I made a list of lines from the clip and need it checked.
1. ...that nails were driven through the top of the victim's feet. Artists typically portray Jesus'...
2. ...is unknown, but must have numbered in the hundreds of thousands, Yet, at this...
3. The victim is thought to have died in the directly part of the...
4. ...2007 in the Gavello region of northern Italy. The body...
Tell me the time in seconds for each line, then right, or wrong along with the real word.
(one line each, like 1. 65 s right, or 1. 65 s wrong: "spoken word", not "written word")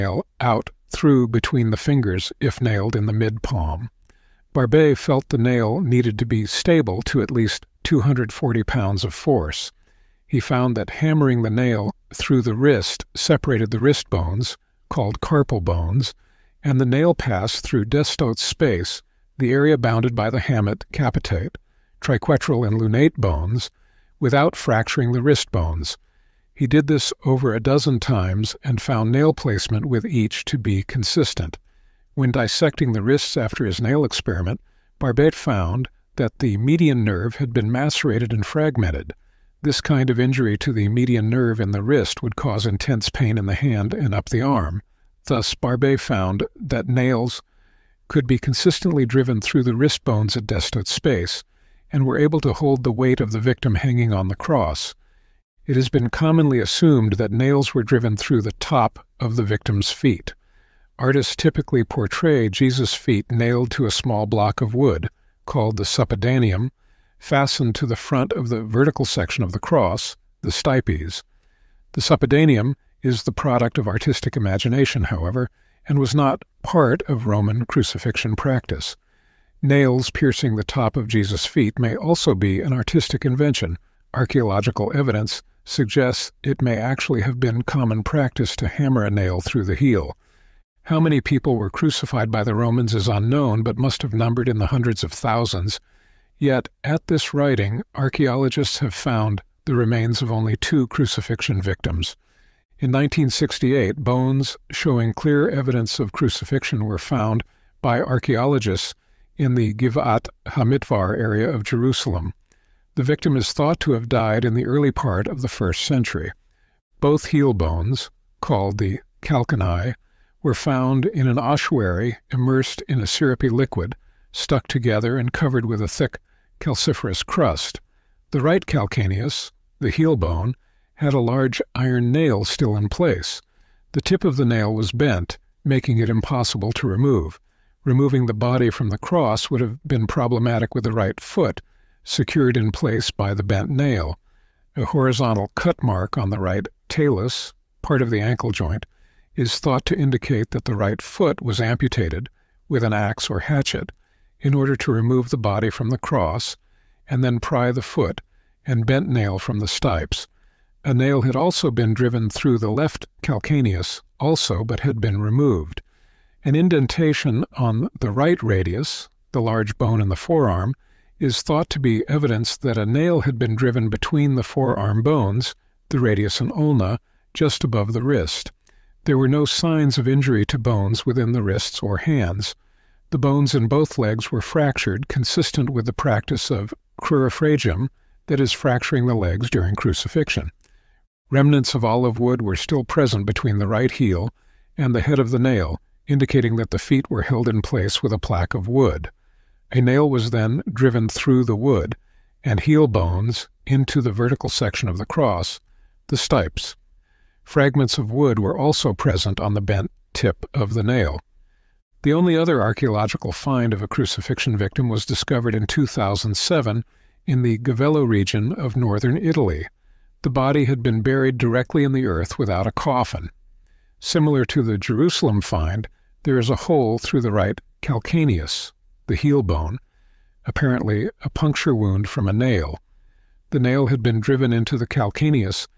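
1. 57 s right
2. 92 s right
3. 112 s wrong: "early", not "directly"
4. 215 s right.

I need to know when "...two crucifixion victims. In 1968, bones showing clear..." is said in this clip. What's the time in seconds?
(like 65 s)
100 s.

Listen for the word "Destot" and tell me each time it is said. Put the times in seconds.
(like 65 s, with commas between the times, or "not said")
17 s, 50 s.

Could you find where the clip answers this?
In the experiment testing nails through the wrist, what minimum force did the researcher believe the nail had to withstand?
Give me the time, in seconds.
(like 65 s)
7 s.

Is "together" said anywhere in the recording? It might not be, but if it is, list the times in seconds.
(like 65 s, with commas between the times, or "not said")
124 s.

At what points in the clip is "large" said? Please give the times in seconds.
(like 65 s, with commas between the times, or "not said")
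131 s, 169 s.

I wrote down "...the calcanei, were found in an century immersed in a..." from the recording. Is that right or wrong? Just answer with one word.
wrong.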